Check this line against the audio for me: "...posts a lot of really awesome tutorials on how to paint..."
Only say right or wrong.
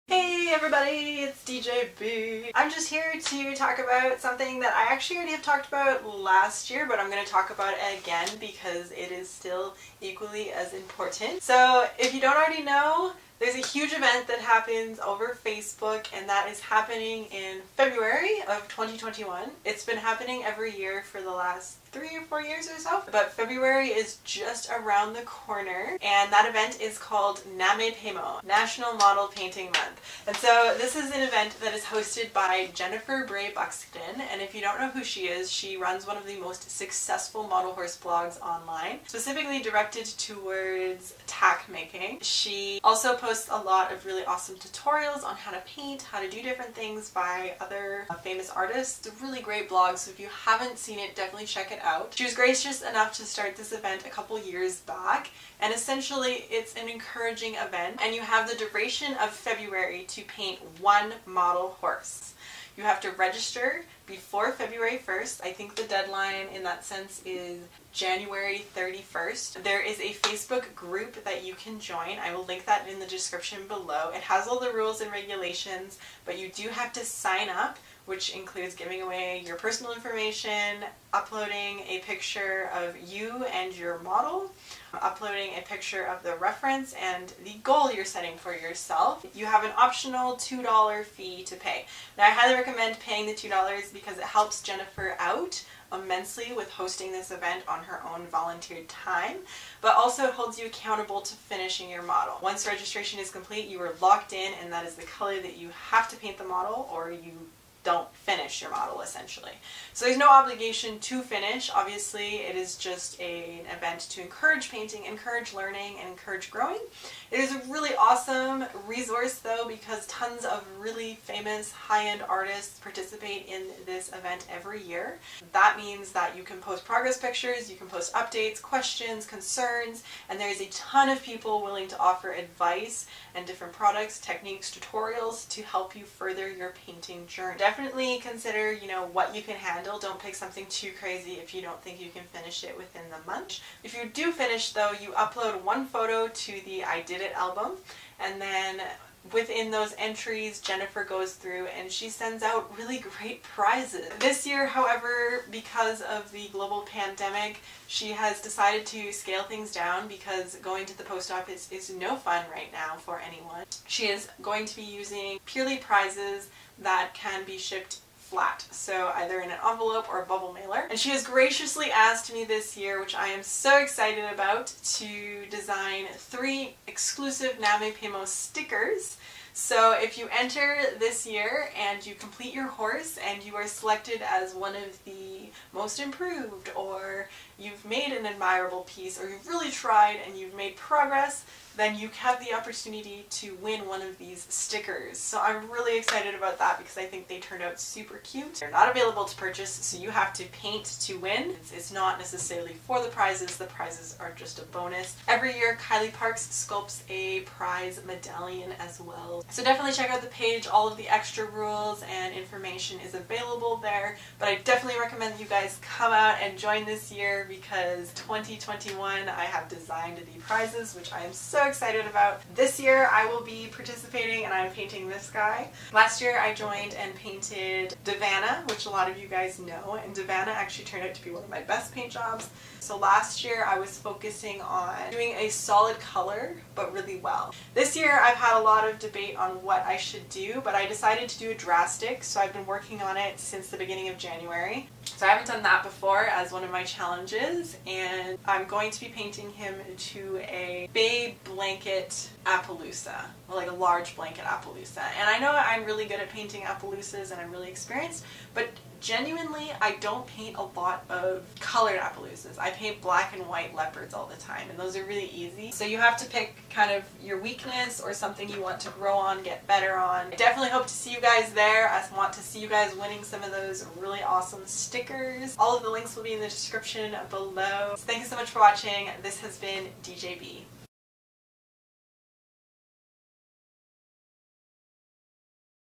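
right.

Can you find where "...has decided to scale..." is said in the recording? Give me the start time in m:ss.
2:38.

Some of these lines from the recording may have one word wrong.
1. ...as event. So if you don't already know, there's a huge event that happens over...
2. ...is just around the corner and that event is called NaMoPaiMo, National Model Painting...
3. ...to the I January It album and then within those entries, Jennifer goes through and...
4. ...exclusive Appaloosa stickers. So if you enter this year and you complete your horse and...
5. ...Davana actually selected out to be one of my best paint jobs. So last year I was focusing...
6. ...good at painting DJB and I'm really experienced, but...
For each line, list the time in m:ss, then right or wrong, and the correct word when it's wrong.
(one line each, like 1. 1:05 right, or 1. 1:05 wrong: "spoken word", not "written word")
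1. 0:10 wrong: "important", not "event"
2. 0:23 right
3. 2:26 wrong: "Did", not "January"
4. 2:56 wrong: "NaMoPaiMo", not "Appaloosa"
5. 3:50 wrong: "turned", not "selected"
6. 4:16 wrong: "Appaloosas", not "DJB".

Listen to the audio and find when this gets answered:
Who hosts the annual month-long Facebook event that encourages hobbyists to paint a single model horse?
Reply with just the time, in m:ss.
0:32.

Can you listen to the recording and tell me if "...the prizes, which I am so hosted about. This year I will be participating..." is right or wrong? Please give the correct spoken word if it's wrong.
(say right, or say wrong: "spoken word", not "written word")
wrong: "excited", not "hosted".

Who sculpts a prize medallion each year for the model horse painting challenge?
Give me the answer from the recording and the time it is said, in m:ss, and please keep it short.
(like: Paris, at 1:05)
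Kylie Parks, at 3:25.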